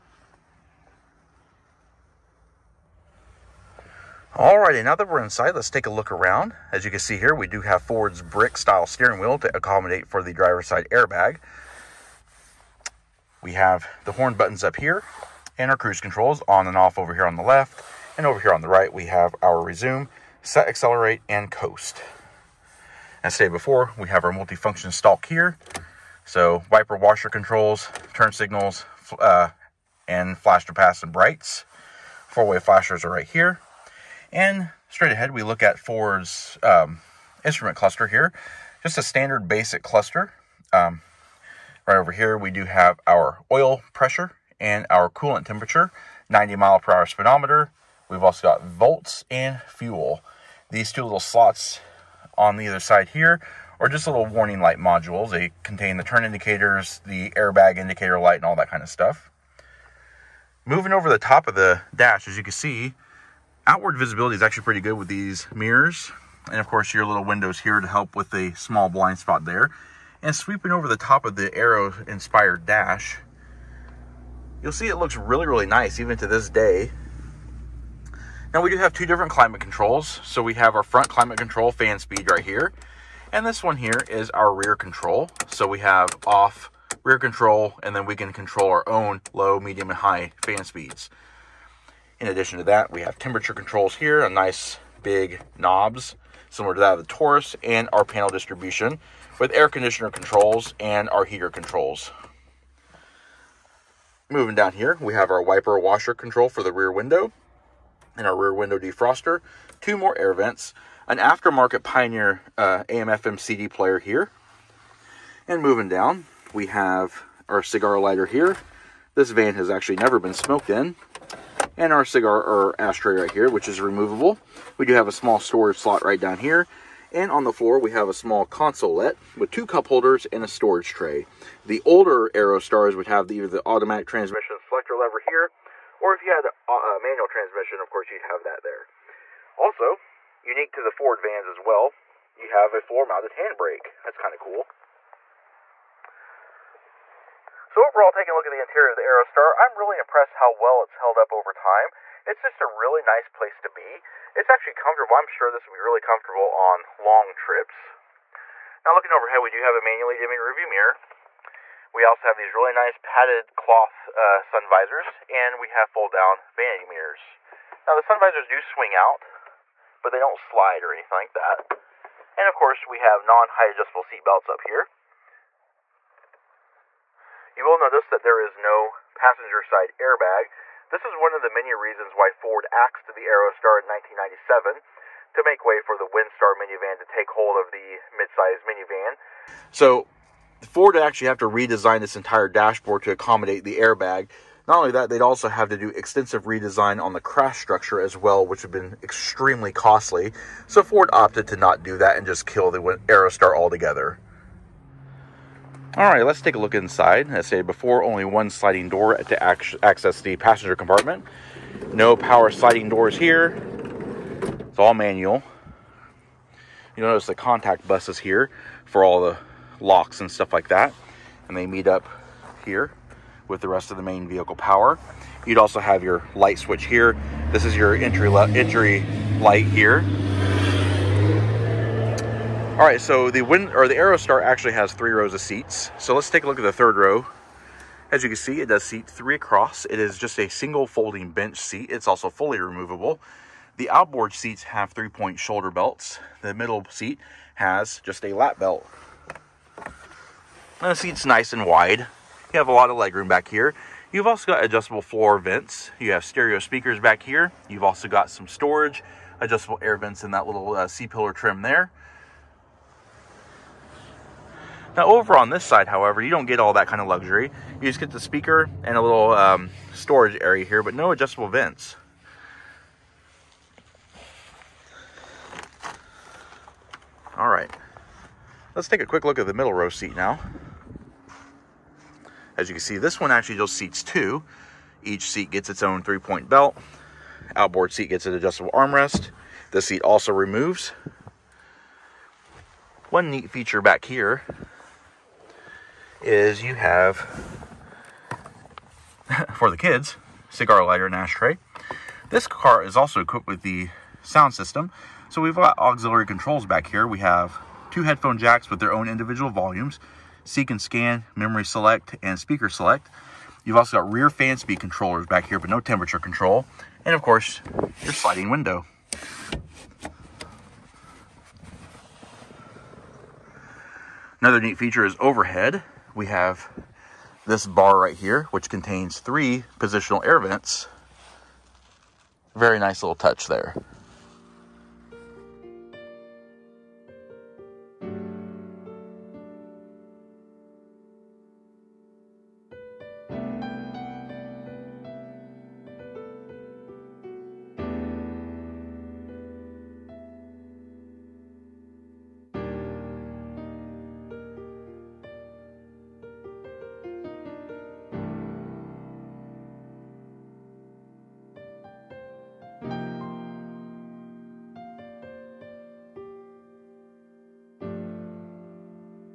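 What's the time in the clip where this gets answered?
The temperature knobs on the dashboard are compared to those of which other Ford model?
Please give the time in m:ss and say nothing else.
1:37.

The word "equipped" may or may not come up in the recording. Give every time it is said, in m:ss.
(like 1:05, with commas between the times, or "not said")
5:03.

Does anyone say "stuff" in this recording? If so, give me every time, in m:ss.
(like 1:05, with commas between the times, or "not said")
0:58, 3:40.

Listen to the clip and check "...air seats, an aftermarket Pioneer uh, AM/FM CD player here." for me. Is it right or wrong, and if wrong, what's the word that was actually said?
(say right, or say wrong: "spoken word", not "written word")
wrong: "vents", not "seats".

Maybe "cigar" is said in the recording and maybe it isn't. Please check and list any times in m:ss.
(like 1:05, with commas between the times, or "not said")
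1:57, 2:02, 5:00.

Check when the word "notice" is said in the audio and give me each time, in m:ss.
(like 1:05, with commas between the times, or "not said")
2:57, 3:37.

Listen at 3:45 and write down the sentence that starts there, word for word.
You'd also have your light switch here.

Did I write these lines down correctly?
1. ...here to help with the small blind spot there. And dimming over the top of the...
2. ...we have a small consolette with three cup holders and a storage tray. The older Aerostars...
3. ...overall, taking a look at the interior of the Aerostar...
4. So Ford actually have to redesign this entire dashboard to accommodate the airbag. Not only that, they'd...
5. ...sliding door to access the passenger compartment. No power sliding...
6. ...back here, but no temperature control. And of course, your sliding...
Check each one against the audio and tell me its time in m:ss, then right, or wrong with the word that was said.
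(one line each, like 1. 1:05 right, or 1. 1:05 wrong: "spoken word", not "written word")
1. 1:07 wrong: "sweeping", not "dimming"
2. 2:07 wrong: "two", not "three"
3. 2:27 right
4. 3:09 right
5. 3:28 right
6. 5:15 right.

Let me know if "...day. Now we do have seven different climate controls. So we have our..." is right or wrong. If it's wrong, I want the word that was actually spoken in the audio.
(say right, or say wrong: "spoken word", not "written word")
wrong: "two", not "seven".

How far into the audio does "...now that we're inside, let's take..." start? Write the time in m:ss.
0:04.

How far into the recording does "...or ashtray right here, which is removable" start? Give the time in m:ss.
2:02.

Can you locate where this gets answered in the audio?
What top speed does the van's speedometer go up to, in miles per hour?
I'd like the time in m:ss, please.
0:46.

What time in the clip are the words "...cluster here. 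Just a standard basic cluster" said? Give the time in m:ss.
0:37.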